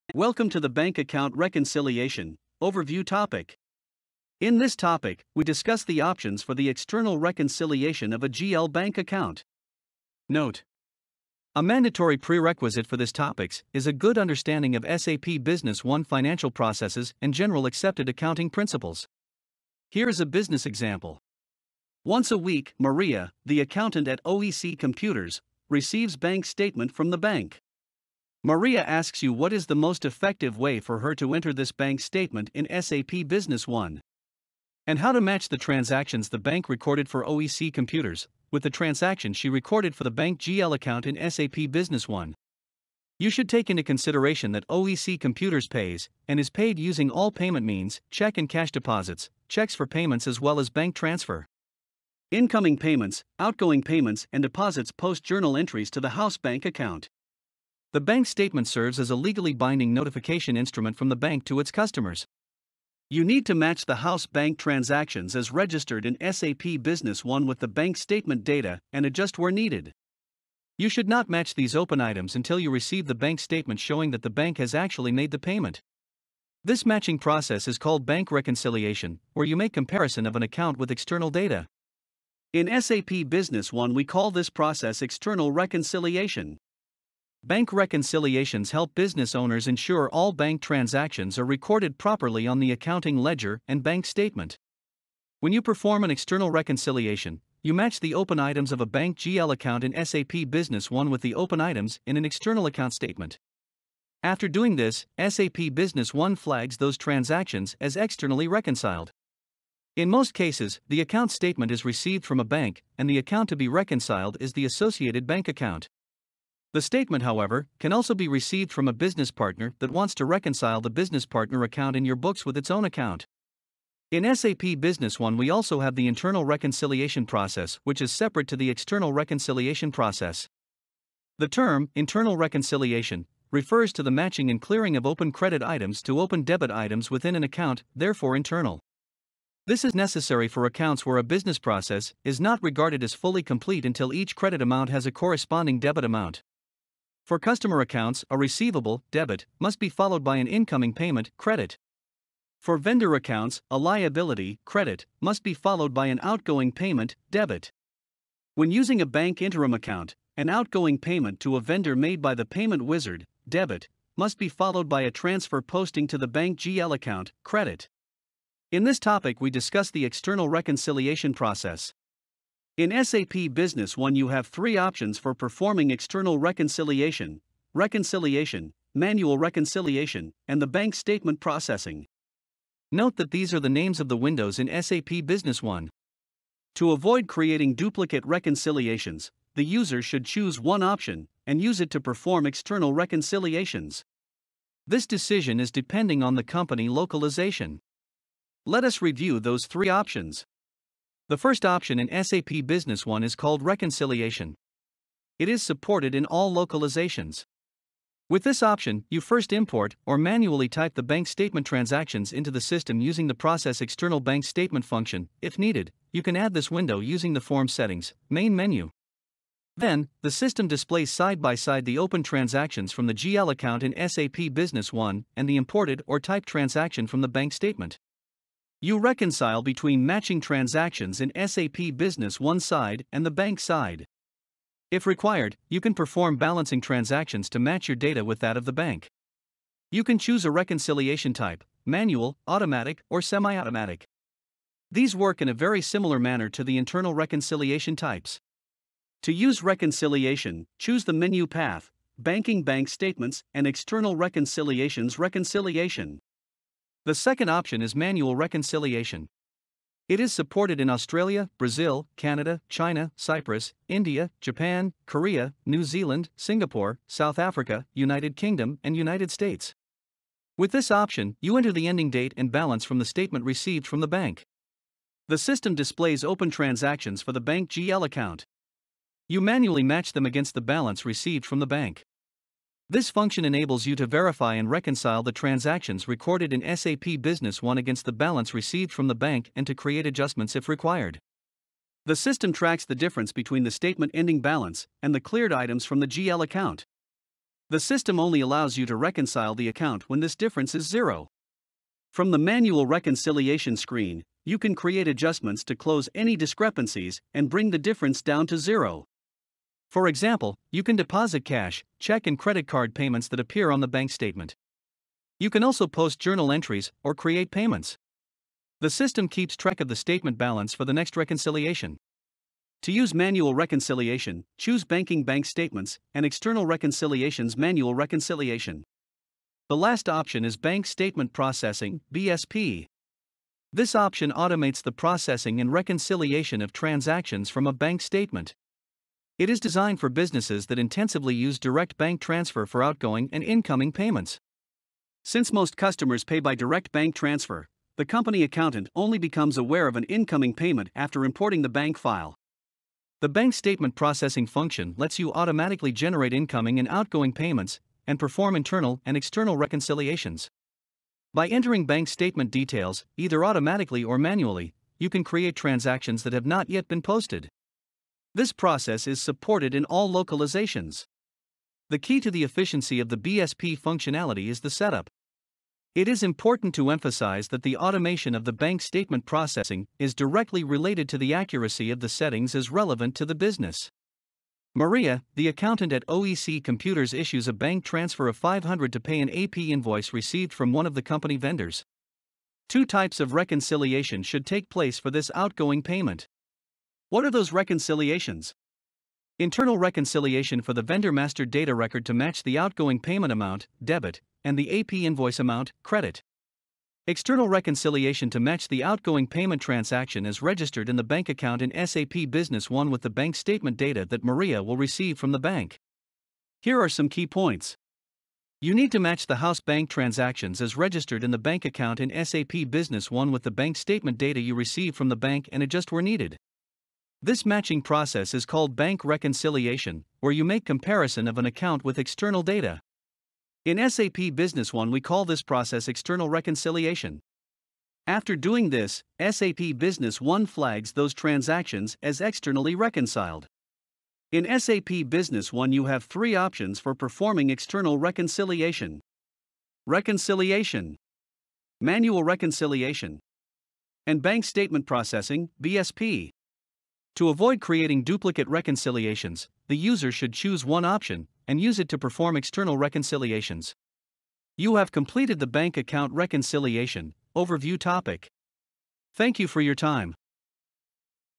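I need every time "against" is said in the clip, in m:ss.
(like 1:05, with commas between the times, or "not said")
4:40, 4:47.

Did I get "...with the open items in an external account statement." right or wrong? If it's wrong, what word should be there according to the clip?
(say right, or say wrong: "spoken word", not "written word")
right.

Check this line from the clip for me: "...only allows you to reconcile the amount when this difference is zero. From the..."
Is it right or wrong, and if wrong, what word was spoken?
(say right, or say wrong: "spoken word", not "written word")
wrong: "account", not "amount".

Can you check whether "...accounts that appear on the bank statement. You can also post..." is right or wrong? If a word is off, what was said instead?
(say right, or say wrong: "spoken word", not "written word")
wrong: "payments", not "accounts".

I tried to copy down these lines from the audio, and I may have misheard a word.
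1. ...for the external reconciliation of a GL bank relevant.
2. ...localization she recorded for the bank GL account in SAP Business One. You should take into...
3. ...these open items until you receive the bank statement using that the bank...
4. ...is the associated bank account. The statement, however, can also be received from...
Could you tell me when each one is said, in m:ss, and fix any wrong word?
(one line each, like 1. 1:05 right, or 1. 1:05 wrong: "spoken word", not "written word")
1. 0:06 wrong: "account", not "relevant"
2. 0:38 wrong: "transaction", not "localization"
3. 1:11 wrong: "showing", not "using"
4. 1:54 right.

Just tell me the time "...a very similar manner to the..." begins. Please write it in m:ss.
4:05.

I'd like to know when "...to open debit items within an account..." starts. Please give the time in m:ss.
2:16.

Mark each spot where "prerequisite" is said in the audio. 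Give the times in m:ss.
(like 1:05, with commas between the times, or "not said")
0:12.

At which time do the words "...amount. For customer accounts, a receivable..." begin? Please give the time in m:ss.
2:26.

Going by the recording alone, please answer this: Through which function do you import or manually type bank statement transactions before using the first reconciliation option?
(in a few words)
process external bank statement.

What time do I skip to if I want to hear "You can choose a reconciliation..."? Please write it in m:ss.
3:59.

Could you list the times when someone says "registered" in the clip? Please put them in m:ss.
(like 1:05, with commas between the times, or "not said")
1:05, 6:50, 7:00.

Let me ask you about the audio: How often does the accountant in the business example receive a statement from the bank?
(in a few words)
Once a week.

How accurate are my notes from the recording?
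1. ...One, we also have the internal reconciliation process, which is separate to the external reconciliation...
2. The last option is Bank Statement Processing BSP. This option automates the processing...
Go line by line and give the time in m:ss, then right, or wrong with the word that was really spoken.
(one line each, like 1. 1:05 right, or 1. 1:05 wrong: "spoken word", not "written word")
1. 2:05 right
2. 5:29 right.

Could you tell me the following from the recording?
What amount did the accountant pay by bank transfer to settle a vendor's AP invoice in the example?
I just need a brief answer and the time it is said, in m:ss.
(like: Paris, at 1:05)
500, at 6:28.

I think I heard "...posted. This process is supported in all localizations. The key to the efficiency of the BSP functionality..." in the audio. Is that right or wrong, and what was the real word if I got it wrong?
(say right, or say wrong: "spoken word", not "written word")
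right.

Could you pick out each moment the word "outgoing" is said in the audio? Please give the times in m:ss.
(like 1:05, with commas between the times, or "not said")
0:53, 2:36, 2:40, 5:42, 5:56, 6:35, 6:42, 6:48.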